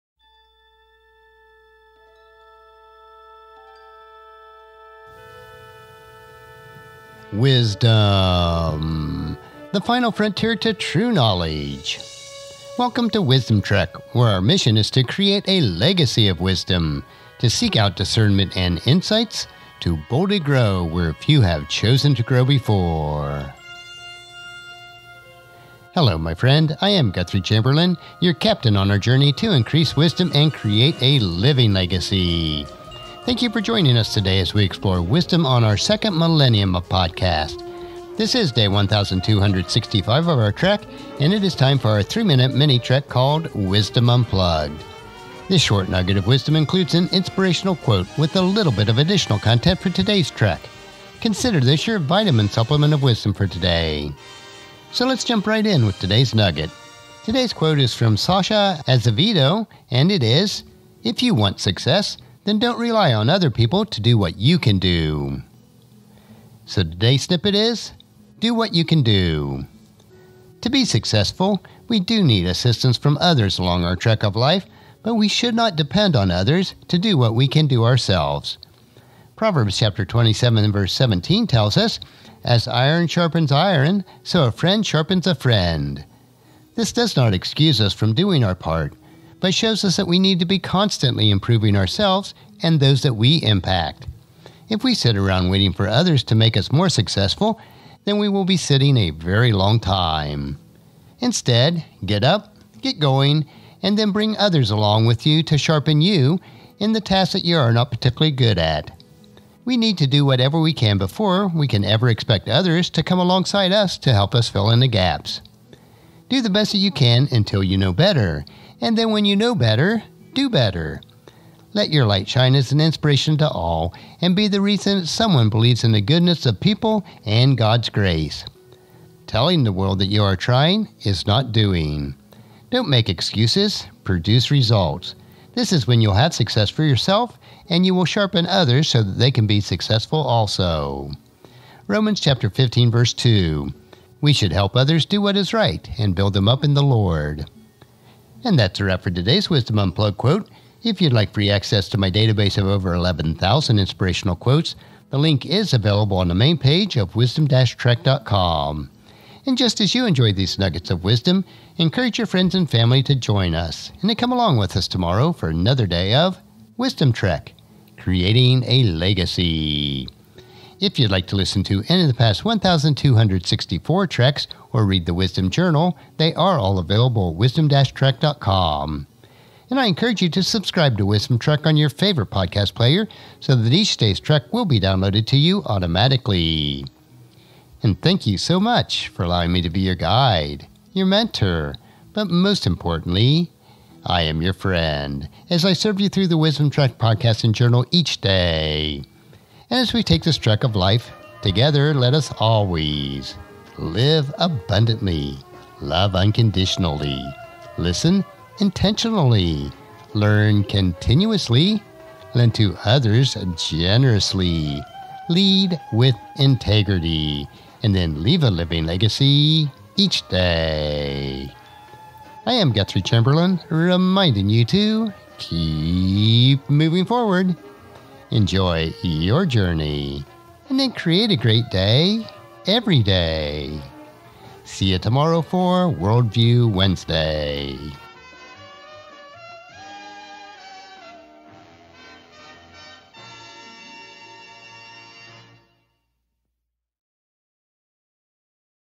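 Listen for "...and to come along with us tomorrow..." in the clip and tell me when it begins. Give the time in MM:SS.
02:44.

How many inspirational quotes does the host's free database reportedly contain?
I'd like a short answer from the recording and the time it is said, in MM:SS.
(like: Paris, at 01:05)
over 11,000, at 02:32.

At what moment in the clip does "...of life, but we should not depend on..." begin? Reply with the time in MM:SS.
01:14.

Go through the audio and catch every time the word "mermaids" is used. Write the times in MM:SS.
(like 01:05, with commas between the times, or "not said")
not said.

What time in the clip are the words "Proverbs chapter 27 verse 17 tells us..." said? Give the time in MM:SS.
01:19.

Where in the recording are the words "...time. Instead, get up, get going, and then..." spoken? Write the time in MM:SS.
01:39.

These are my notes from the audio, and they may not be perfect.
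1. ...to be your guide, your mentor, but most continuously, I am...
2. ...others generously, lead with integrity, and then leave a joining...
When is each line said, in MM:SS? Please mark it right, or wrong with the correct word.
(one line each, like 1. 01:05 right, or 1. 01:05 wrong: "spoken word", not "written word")
1. 03:09 wrong: "importantly", not "continuously"
2. 03:32 wrong: "living", not "joining".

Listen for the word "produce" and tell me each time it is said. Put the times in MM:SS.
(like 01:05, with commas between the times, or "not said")
02:14.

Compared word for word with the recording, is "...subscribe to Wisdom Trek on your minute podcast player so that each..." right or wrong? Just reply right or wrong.
wrong.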